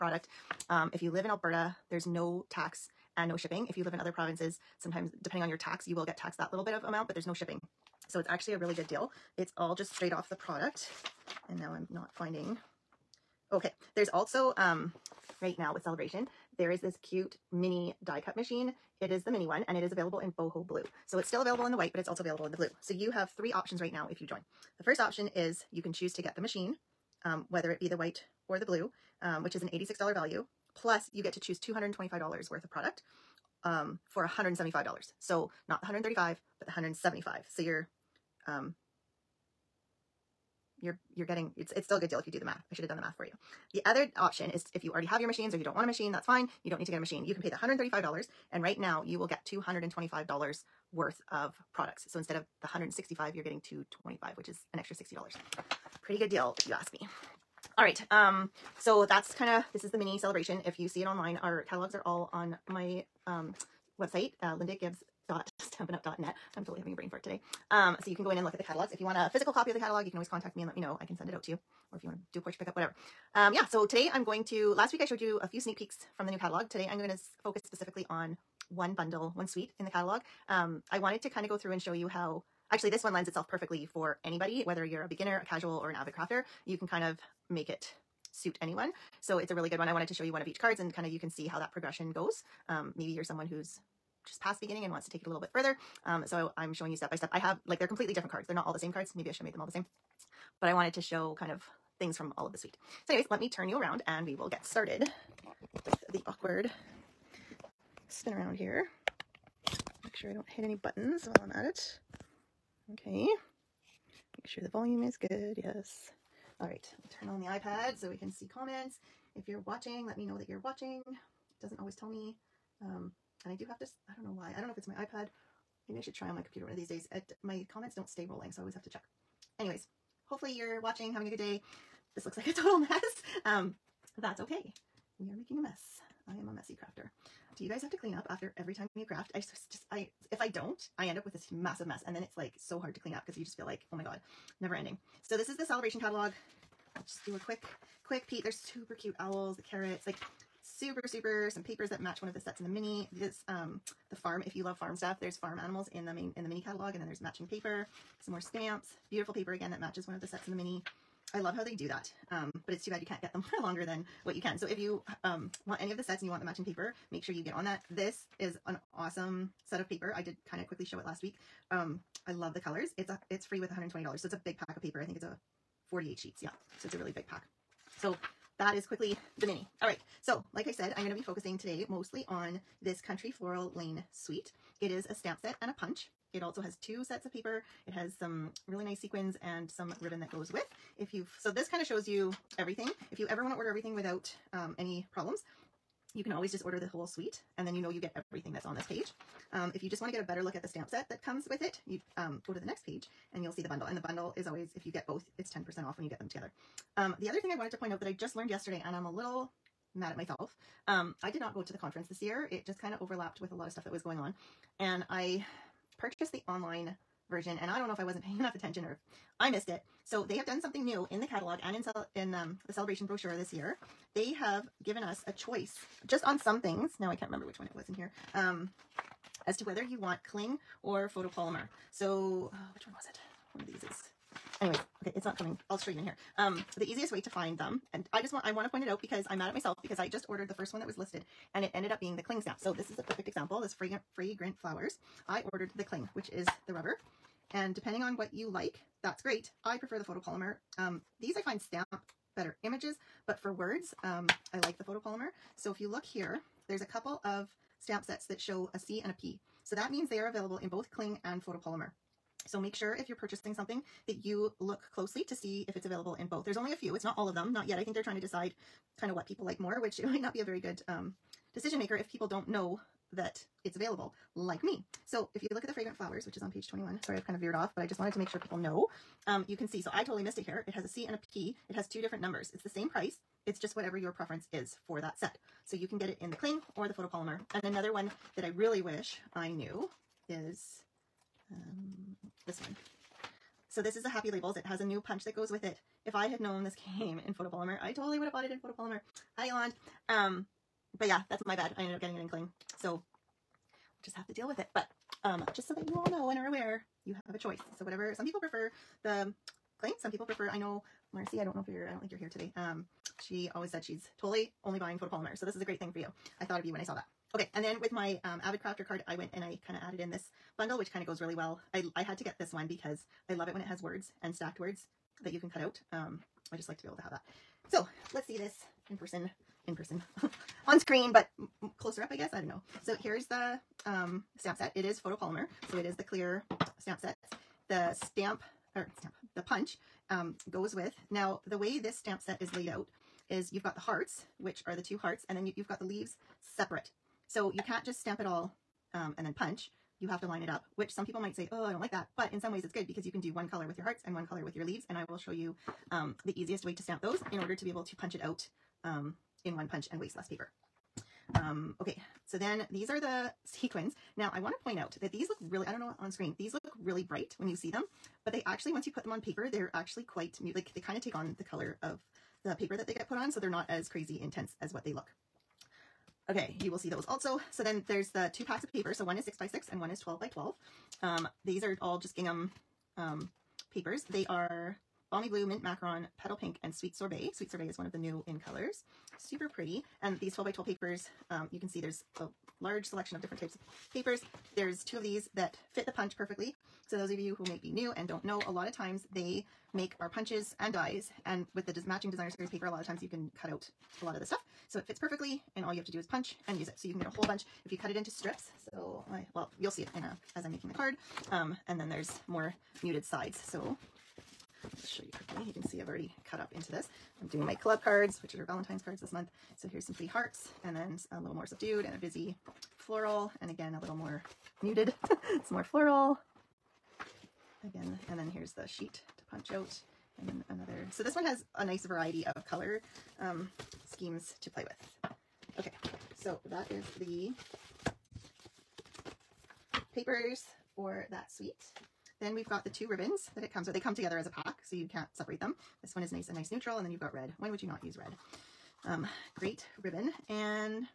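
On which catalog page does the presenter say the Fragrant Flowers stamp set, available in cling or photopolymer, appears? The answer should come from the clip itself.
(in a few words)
21.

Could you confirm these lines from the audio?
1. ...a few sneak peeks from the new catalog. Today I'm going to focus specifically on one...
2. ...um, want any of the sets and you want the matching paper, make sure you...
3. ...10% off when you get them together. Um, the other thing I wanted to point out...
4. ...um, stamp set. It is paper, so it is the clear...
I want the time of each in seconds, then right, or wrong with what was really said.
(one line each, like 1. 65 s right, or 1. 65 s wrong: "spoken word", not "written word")
1. 75 s right
2. 165 s right
3. 205 s right
4. 333 s wrong: "photopolymer", not "paper".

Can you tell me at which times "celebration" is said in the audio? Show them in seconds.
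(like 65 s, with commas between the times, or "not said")
15 s, 60 s, 145 s, 222 s.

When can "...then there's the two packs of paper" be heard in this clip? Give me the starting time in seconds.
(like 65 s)
377 s.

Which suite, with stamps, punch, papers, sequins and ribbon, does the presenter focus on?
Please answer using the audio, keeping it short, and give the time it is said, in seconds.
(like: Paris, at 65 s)
Country Floral Lane, at 183 s.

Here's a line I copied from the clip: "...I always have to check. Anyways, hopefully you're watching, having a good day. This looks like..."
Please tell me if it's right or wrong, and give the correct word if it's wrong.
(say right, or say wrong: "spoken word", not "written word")
right.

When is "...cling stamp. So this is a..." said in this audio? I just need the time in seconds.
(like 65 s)
242 s.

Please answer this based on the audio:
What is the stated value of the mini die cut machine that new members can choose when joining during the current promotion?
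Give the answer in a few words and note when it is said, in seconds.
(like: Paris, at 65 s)
$86, at 29 s.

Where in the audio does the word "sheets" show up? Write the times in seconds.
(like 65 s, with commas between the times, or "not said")
176 s, 428 s.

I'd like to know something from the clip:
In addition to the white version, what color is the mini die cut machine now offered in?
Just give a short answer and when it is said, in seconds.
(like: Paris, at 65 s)
boho blue, at 20 s.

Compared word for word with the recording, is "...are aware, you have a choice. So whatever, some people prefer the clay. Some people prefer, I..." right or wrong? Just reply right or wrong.
right.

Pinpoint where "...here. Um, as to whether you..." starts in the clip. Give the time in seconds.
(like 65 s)
227 s.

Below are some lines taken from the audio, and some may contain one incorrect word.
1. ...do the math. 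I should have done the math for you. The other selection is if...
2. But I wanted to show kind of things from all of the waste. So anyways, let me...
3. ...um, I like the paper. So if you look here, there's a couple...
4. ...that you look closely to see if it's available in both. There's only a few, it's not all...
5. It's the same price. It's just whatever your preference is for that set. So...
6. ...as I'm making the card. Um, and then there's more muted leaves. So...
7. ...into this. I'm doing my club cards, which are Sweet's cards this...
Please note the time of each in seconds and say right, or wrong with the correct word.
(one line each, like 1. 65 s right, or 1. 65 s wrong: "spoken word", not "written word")
1. 42 s wrong: "option", not "selection"
2. 100 s wrong: "suite", not "waste"
3. 254 s wrong: "photopolymer", not "paper"
4. 264 s right
5. 282 s right
6. 410 s wrong: "sides", not "leaves"
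7. 416 s wrong: "Valentine", not "Sweet".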